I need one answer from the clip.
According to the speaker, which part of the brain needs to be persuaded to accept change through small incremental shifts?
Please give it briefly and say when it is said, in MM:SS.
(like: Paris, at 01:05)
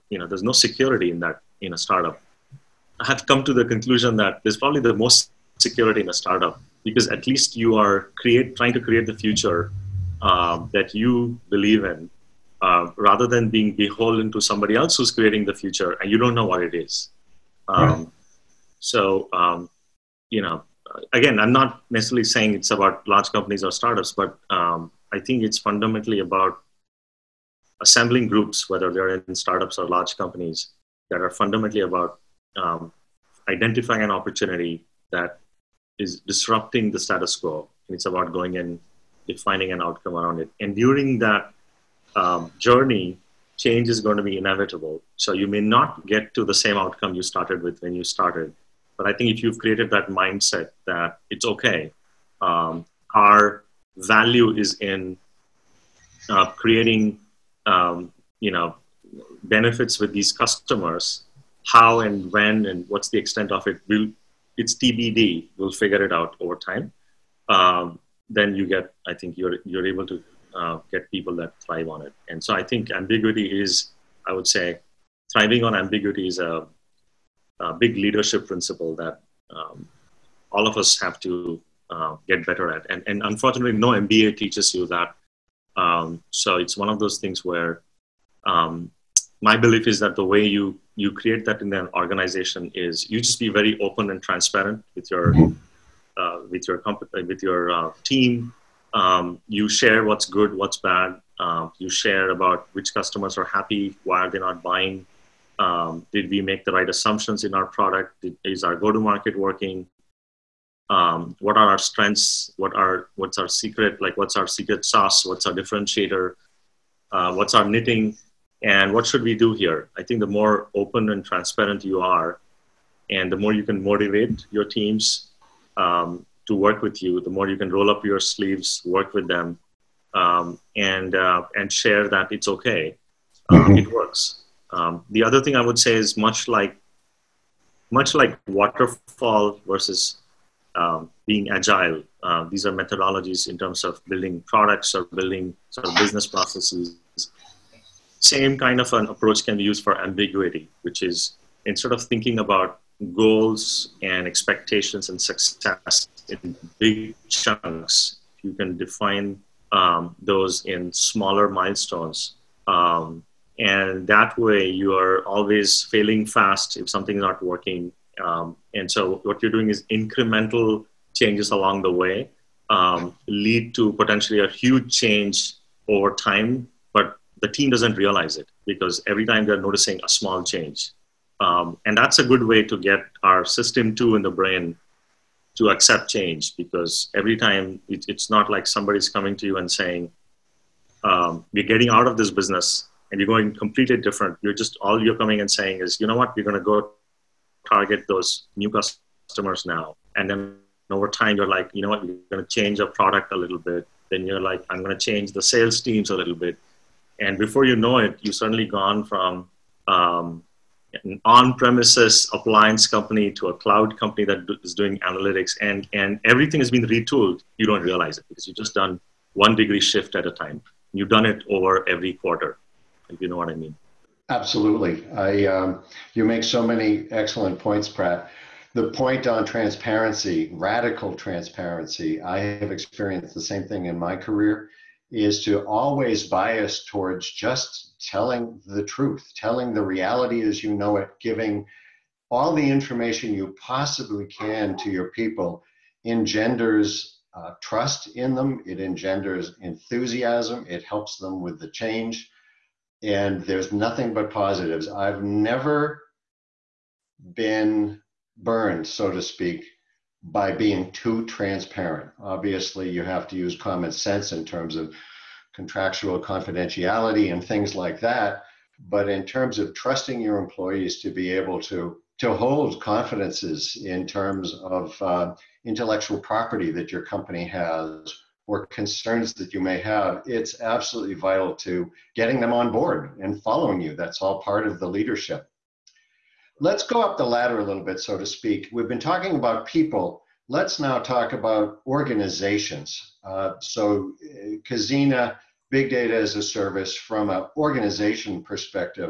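System two, at 03:03.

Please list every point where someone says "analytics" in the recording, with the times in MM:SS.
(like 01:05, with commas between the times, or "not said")
03:34.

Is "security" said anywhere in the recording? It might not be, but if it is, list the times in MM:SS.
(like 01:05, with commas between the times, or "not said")
00:00, 00:05.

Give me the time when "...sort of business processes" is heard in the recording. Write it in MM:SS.
02:25.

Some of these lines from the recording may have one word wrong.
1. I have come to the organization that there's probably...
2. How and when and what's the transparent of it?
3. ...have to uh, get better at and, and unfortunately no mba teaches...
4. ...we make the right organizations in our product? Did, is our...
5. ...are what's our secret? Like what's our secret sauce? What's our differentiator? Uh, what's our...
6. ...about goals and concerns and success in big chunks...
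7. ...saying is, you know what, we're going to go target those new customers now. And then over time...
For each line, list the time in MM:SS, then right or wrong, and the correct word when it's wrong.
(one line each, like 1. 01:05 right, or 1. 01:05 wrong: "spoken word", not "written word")
1. 00:02 wrong: "conclusion", not "organization"
2. 01:01 wrong: "extent", not "transparent"
3. 01:20 right
4. 01:46 wrong: "assumptions", not "organizations"
5. 01:52 right
6. 02:32 wrong: "expectations", not "concerns"
7. 03:15 right.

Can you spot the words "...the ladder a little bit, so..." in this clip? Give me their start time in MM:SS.
04:47.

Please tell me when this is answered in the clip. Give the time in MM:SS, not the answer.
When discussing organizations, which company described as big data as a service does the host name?
04:54.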